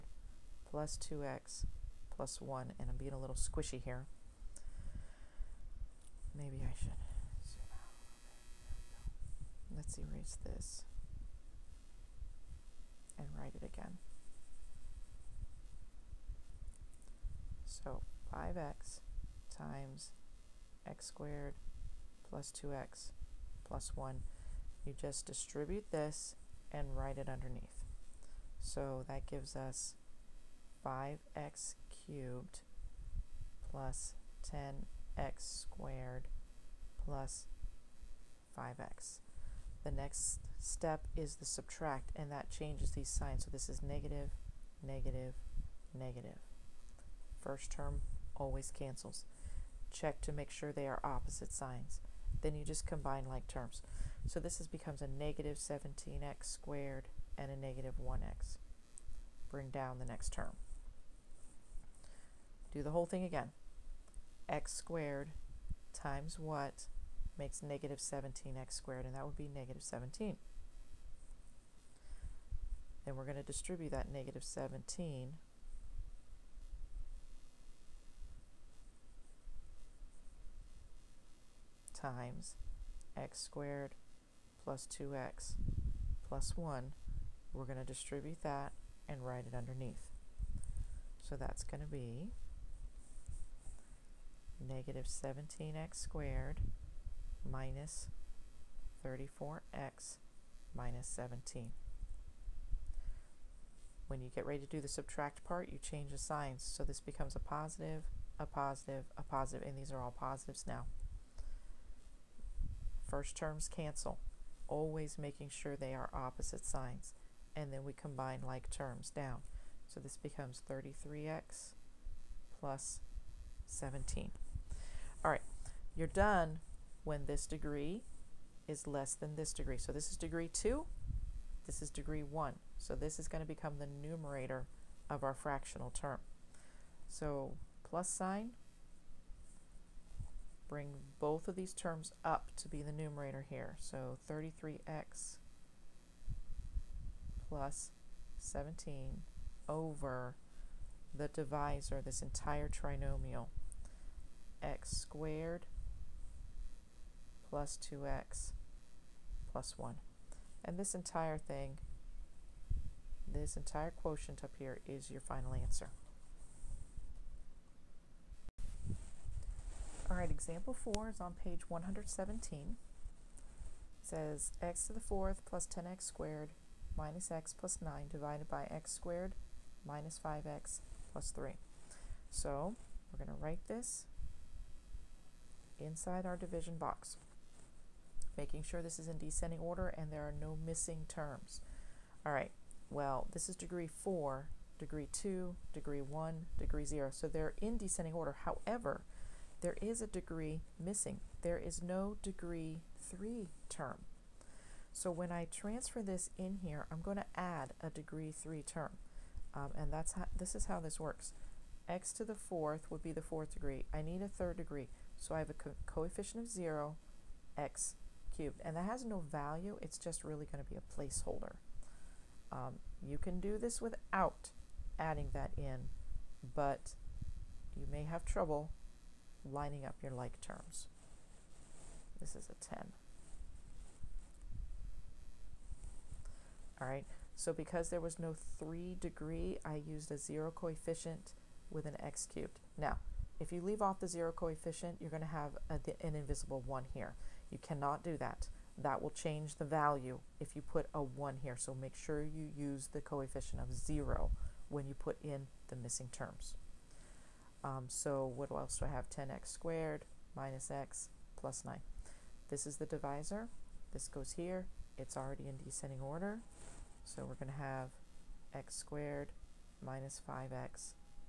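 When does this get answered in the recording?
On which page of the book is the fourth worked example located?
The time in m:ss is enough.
2:51.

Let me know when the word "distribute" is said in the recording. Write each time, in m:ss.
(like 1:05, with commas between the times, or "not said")
0:25, 1:13, 1:27.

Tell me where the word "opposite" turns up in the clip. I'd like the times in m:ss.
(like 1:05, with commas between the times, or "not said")
0:51, 1:56.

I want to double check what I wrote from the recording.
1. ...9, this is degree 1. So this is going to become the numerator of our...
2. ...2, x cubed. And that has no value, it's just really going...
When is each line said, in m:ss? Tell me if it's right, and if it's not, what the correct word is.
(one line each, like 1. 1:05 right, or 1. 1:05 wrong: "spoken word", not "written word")
1. 2:10 wrong: "2", not "9"
2. 3:36 wrong: "0", not "2".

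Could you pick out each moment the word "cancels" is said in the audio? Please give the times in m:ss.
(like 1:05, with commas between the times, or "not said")
0:48, 1:53.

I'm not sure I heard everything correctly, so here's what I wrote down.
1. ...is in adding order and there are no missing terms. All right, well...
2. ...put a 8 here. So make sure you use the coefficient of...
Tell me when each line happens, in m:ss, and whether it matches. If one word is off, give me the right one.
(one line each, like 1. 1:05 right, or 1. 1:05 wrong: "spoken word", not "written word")
1. 3:08 wrong: "descending", not "adding"
2. 4:10 wrong: "1", not "8".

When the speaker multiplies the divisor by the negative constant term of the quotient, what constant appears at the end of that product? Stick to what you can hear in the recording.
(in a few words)
-17.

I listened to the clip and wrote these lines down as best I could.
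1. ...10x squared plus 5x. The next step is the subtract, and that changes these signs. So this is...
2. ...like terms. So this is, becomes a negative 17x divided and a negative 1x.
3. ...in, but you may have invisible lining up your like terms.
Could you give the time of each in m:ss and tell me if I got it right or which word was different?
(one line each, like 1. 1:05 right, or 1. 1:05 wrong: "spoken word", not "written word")
1. 0:34 right
2. 0:53 wrong: "squared", not "divided"
3. 3:45 wrong: "trouble", not "invisible".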